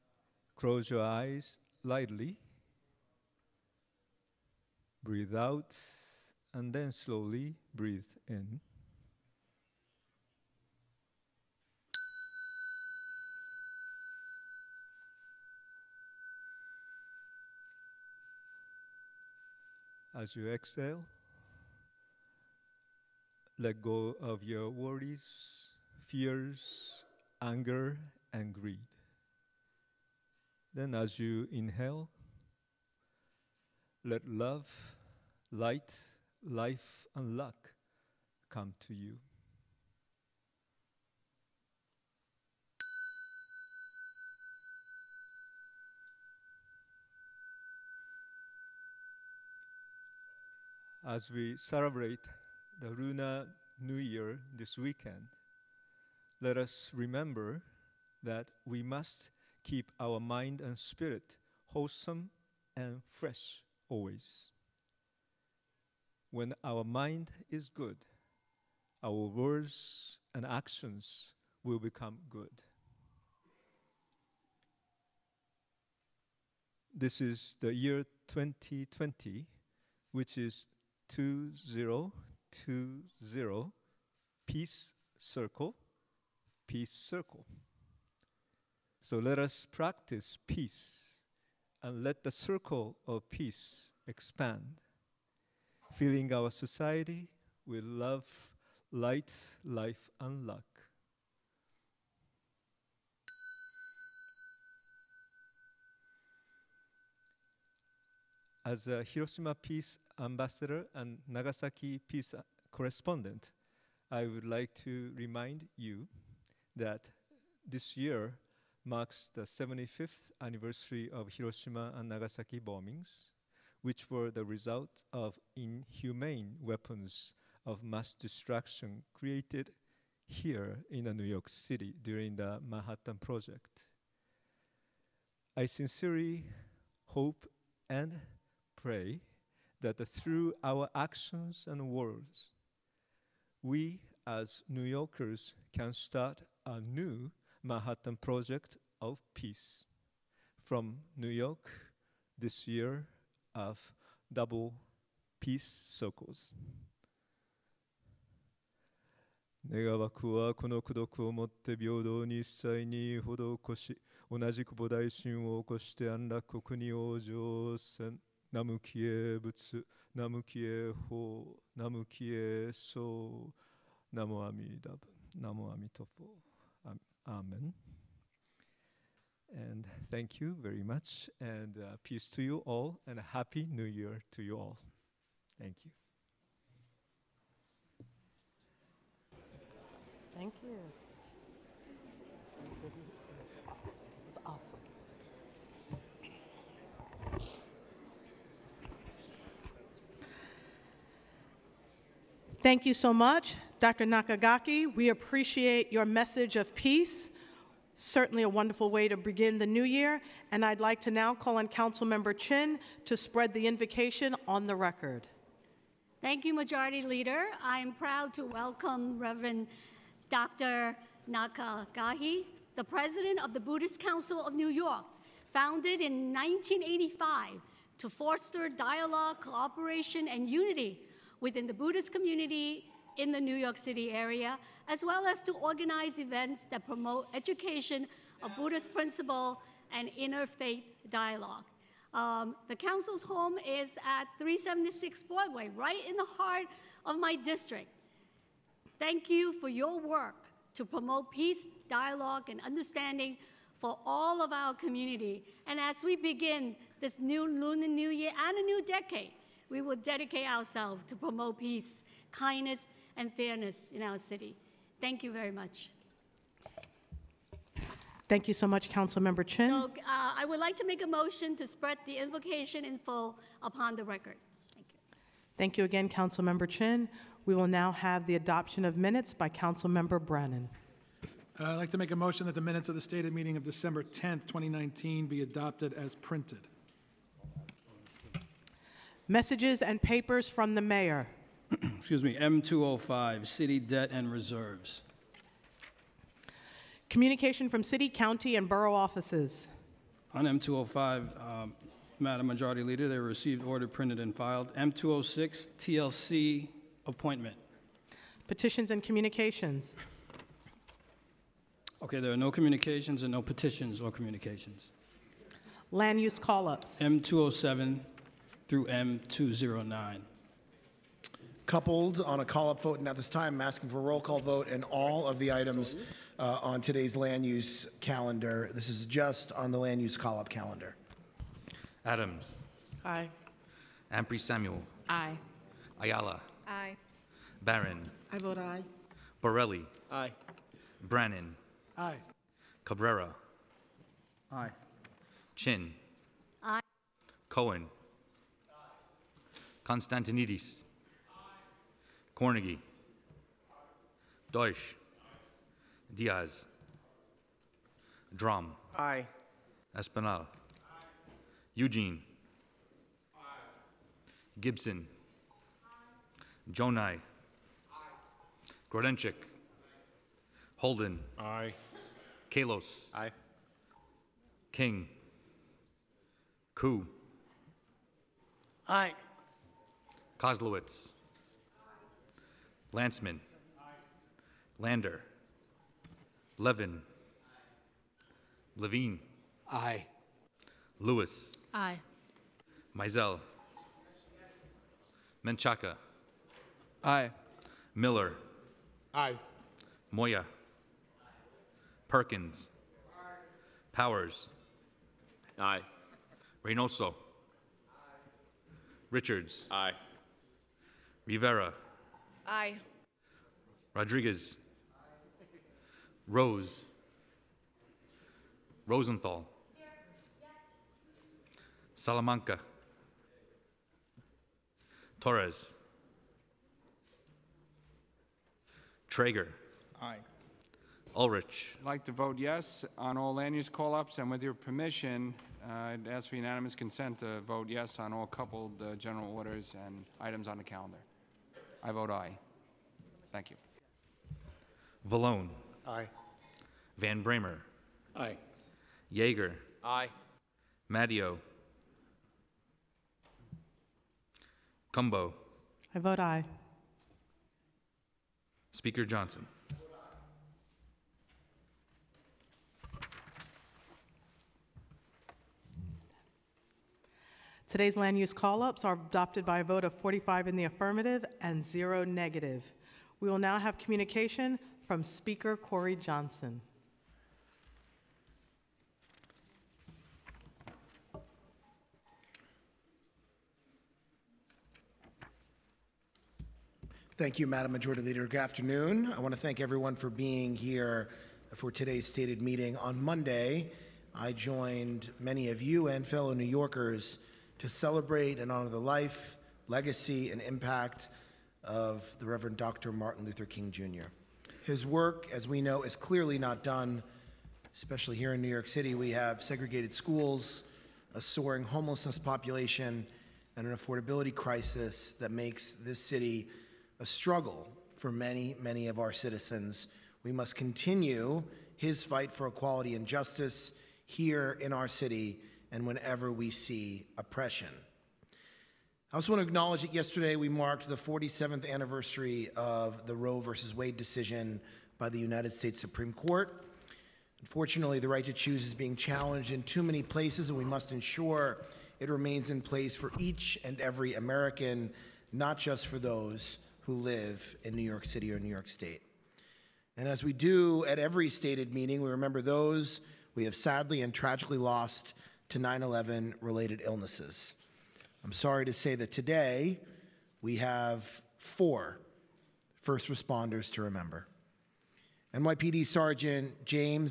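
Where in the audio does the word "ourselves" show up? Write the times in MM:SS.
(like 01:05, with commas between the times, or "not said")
04:20.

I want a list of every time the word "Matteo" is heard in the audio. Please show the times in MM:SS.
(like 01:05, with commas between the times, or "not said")
07:30.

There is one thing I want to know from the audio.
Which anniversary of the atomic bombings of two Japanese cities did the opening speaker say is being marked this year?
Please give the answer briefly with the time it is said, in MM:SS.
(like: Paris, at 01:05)
75th, at 01:59.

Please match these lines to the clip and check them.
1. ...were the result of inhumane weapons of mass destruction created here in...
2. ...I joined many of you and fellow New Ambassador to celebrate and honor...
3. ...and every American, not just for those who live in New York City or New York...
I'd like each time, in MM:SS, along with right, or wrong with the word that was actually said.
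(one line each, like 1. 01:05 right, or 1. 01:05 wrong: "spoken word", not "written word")
1. 02:04 right
2. 08:14 wrong: "Yorkers", not "Ambassador"
3. 09:03 right.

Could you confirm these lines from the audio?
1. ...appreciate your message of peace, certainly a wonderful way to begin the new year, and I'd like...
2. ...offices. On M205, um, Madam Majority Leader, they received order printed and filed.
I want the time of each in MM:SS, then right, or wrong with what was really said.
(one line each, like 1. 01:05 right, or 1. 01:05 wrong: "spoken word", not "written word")
1. 03:25 right
2. 04:58 right.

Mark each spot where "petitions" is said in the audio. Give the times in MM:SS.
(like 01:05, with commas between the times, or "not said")
05:08, 05:13.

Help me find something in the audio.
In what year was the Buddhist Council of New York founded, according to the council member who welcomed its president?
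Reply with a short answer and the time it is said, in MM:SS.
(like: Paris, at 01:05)
1985, at 03:46.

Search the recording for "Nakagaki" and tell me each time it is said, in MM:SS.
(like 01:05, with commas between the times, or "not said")
03:24, 03:41.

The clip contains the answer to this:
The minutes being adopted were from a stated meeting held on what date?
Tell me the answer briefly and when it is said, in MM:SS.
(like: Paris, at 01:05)
December 10th, 2019, at 04:43.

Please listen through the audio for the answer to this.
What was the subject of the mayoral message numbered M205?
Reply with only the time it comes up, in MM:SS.
04:53.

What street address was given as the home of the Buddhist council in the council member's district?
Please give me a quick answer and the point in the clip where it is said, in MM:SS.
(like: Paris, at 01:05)
376 Broadway, at 04:04.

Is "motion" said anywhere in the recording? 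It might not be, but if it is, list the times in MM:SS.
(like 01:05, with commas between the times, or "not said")
04:31, 04:42.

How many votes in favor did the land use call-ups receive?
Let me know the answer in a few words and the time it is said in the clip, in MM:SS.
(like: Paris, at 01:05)
45, at 07:49.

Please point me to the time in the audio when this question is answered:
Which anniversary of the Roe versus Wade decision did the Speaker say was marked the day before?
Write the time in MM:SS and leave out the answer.
08:50.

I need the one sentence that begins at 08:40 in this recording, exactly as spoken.
We must continue his fight for equality and justice here in our city and whenever we see oppression.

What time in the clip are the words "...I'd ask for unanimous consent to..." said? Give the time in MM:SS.
07:15.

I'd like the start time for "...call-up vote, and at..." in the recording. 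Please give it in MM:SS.
05:22.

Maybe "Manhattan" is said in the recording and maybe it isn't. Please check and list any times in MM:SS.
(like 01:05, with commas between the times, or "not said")
02:12, 02:27.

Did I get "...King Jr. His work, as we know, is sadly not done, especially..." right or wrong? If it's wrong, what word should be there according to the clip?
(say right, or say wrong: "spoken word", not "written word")
wrong: "clearly", not "sadly".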